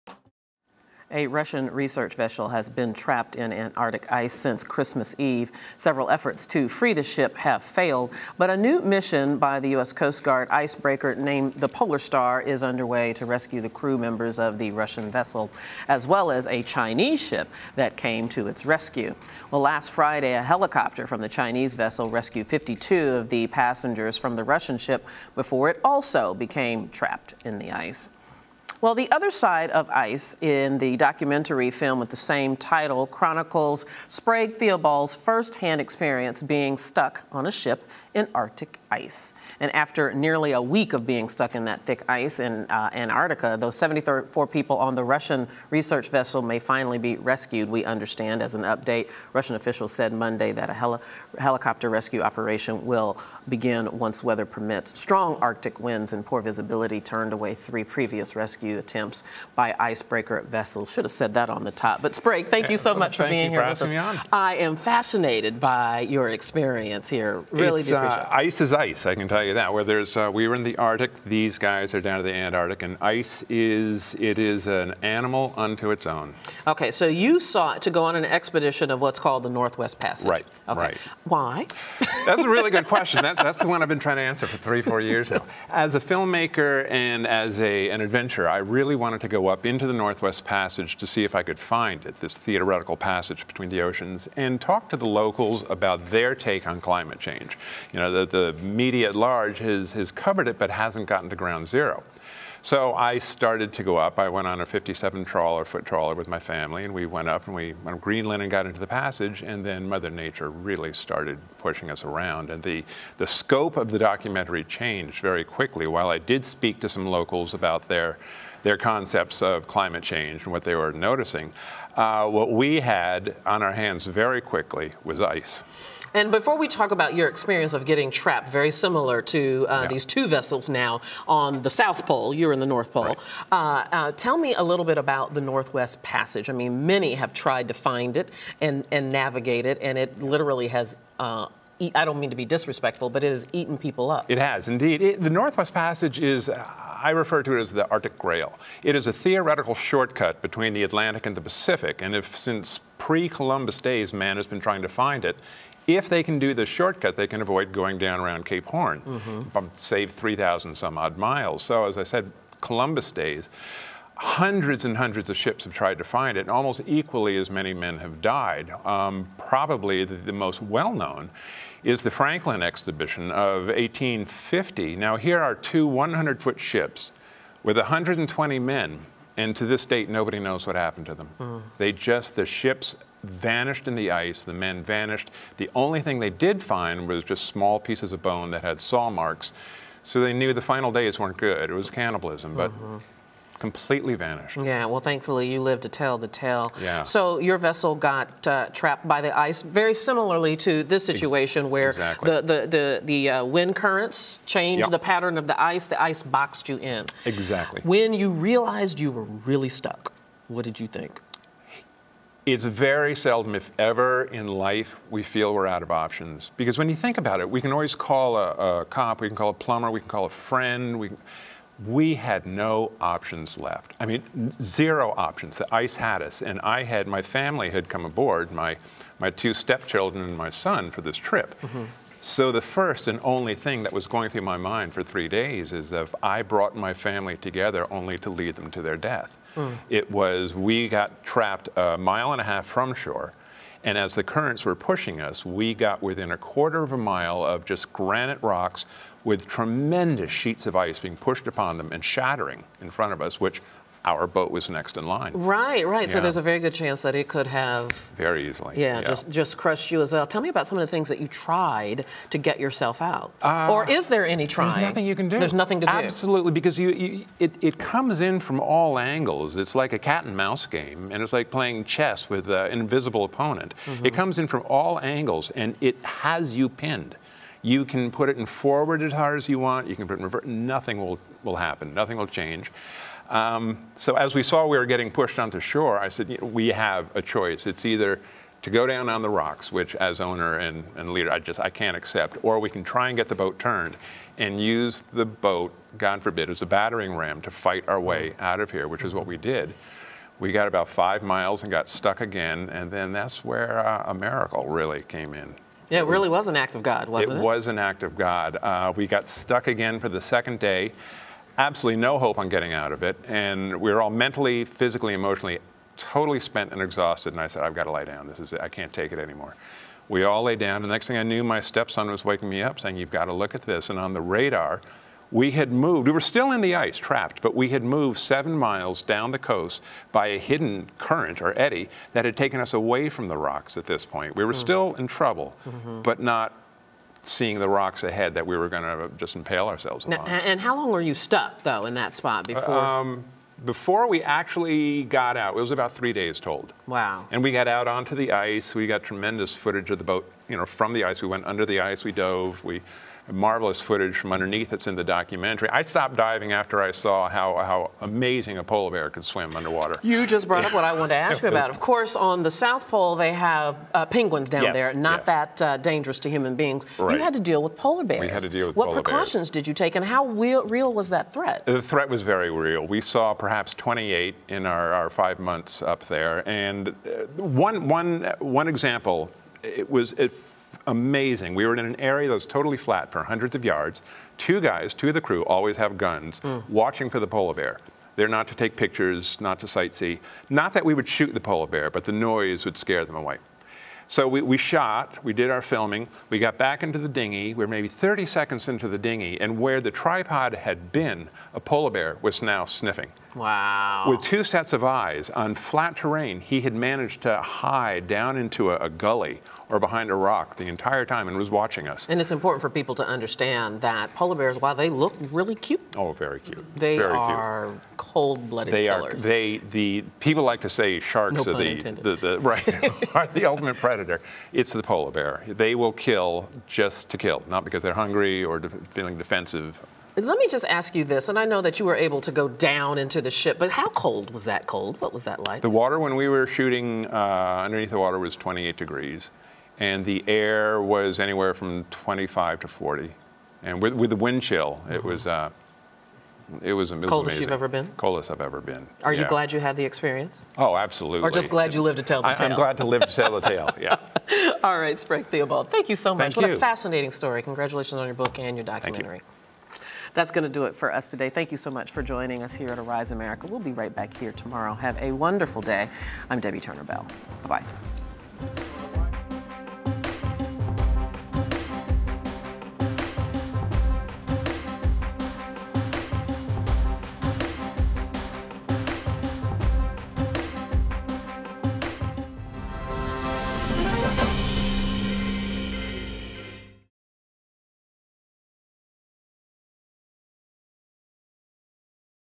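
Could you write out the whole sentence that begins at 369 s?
What precautions did you take, and how real, real, was that threat?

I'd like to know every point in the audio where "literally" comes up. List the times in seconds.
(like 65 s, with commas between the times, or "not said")
140 s.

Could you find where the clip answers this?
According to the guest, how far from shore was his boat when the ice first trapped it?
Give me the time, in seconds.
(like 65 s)
241 s.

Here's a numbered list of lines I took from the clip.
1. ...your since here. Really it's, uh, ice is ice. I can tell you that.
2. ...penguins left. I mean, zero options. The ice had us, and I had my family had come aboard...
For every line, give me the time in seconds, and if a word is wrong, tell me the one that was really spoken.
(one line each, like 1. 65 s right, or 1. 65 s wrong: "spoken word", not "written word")
1. 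66 s wrong: "experience", not "since"
2. 222 s wrong: "options", not "penguins".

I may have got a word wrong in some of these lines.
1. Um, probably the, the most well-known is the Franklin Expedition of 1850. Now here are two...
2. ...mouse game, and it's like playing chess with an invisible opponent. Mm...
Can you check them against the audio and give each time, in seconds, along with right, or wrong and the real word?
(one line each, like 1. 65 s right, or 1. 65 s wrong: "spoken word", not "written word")
1. 168 s right
2. 270 s right.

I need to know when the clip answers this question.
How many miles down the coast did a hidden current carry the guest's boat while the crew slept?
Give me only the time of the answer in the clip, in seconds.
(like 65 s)
328 s.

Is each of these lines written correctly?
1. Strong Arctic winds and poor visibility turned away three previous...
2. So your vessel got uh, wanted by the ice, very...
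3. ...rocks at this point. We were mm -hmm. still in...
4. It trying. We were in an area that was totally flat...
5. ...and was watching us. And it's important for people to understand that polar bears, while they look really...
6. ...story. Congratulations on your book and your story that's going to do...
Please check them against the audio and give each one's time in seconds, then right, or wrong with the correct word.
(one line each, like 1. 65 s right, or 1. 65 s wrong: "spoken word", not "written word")
1. 54 s right
2. 197 s wrong: "trapped", not "wanted"
3. 333 s right
4. 380 s wrong: "amazing", not "trying"
5. 411 s right
6. 457 s wrong: "documentary", not "story".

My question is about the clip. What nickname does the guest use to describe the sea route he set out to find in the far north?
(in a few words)
the Arctic Grail.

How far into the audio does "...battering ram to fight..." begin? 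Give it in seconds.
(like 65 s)
296 s.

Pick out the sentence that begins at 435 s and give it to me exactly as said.
The water when we were shooting uh, underneath the water was 28 degrees, and the air was anywhere from 25 to 40.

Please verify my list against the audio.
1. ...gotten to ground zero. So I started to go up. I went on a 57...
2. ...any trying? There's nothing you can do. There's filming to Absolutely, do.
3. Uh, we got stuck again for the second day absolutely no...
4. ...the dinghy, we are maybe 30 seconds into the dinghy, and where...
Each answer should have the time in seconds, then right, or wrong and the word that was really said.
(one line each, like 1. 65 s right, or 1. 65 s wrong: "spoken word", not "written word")
1. 101 s right
2. 264 s wrong: "nothing", not "filming"
3. 308 s right
4. 396 s right.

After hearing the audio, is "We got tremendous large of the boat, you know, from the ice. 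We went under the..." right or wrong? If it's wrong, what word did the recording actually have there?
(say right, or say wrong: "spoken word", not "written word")
wrong: "footage", not "large".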